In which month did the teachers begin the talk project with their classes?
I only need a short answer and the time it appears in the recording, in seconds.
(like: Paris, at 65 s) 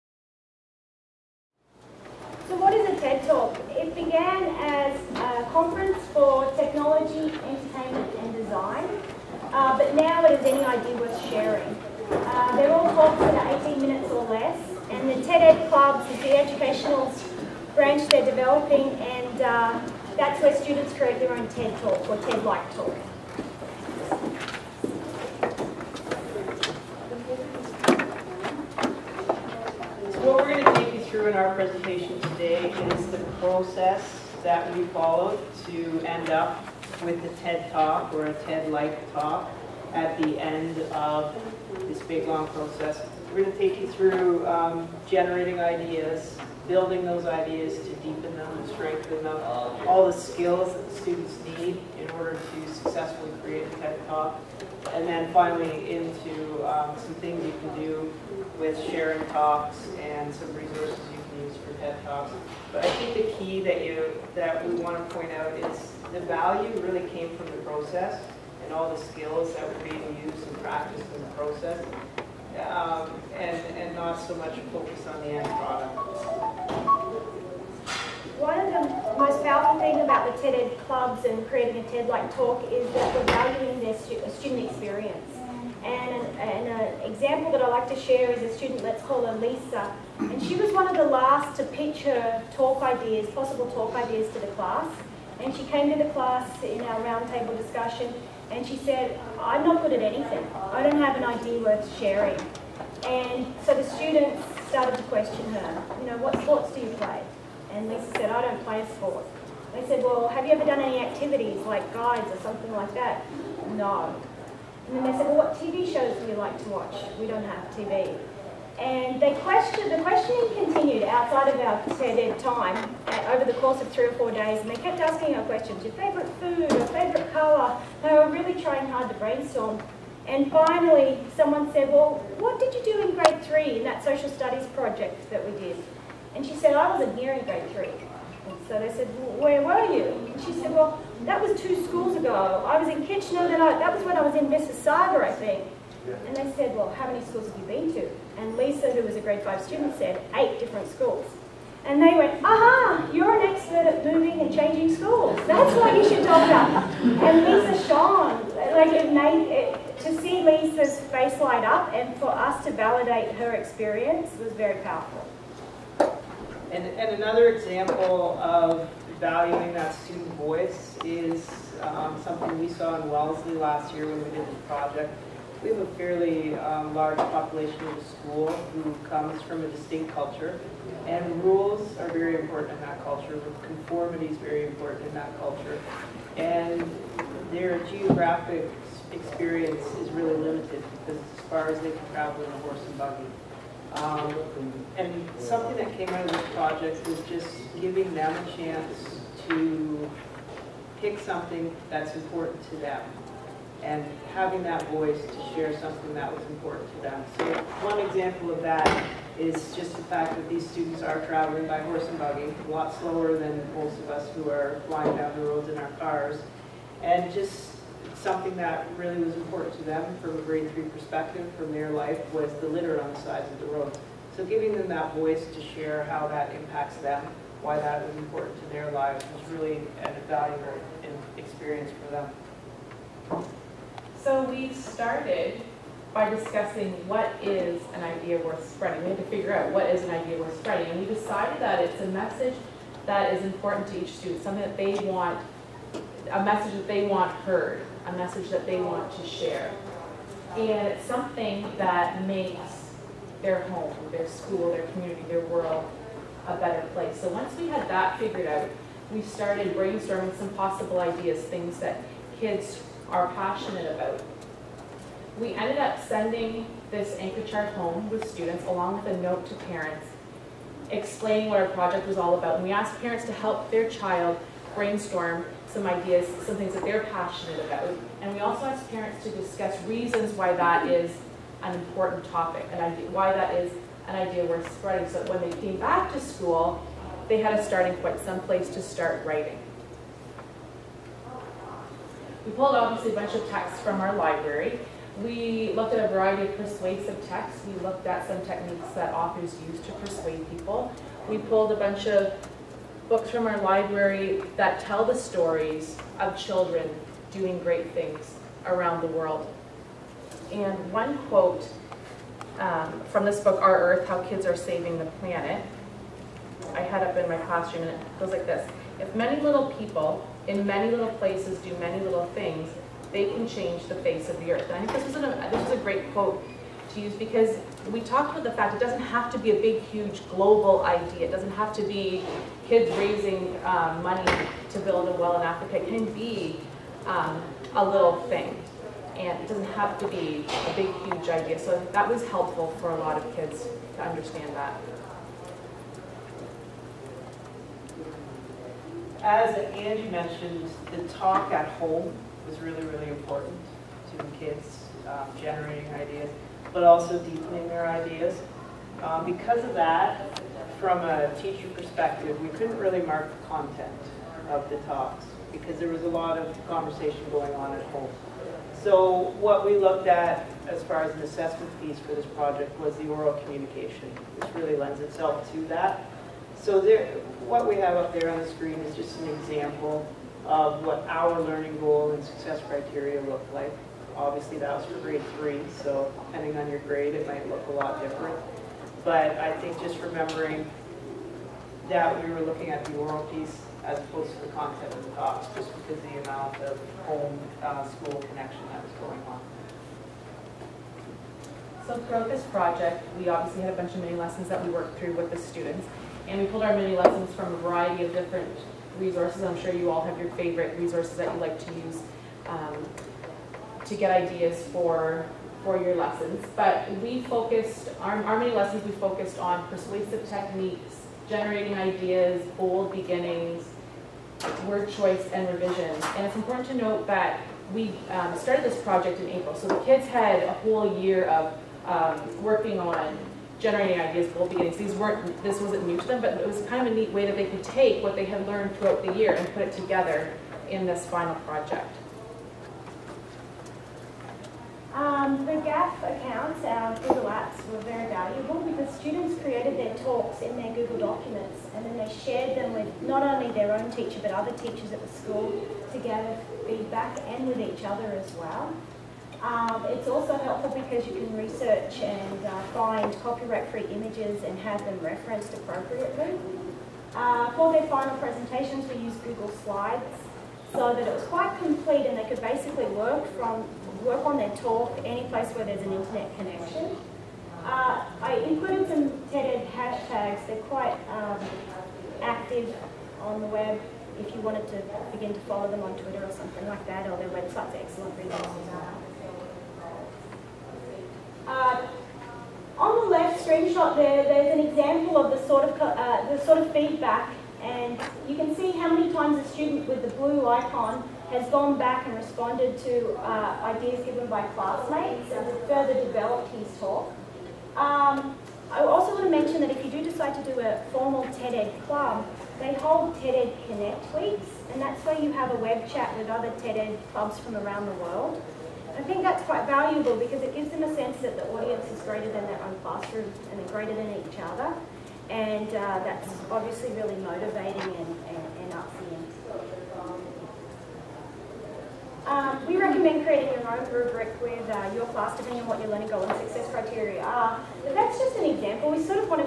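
April, at 429 s.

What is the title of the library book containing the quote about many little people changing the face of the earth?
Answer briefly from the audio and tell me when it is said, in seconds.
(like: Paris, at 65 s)
Our Earth, How Kids Are Saving the Planet, at 313 s.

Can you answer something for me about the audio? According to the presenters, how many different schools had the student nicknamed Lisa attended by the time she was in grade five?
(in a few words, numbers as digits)
8.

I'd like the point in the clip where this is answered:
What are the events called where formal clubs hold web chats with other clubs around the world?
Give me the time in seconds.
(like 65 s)
513 s.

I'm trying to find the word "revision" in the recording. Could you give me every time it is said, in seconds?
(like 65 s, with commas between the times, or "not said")
425 s.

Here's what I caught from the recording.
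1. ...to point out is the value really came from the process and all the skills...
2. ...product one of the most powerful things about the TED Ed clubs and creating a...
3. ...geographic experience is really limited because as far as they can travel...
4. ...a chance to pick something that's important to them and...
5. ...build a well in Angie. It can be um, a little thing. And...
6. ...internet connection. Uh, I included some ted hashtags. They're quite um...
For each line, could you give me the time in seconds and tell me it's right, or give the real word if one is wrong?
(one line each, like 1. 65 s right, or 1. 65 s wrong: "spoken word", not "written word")
1. 64 s right
2. 75 s right
3. 187 s right
4. 198 s right
5. 334 s wrong: "Africa", not "Angie"
6. 475 s right.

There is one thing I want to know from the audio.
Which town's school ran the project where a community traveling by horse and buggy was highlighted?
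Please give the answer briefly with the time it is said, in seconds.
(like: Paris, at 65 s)
Wellesley, at 173 s.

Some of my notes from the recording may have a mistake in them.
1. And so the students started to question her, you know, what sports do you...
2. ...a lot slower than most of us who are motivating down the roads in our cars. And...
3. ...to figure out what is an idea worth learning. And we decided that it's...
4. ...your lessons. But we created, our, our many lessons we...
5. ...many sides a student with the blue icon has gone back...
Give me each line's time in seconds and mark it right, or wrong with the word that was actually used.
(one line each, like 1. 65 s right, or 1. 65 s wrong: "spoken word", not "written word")
1. 103 s right
2. 212 s wrong: "flying", not "motivating"
3. 239 s wrong: "spreading", not "learning"
4. 415 s wrong: "focused", not "created"
5. 498 s wrong: "times", not "sides".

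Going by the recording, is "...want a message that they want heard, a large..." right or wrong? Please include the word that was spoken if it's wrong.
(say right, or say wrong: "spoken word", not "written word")
wrong: "message", not "large".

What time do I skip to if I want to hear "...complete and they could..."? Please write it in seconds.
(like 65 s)
471 s.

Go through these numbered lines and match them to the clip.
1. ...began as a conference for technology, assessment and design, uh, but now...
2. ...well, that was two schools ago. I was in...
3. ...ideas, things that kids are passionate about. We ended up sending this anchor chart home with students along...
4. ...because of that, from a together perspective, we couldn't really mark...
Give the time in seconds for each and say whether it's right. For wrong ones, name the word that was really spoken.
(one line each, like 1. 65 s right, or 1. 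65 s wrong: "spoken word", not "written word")
1. 3 s wrong: "entertainment", not "assessment"
2. 140 s right
3. 260 s right
4. 359 s wrong: "teacher", not "together".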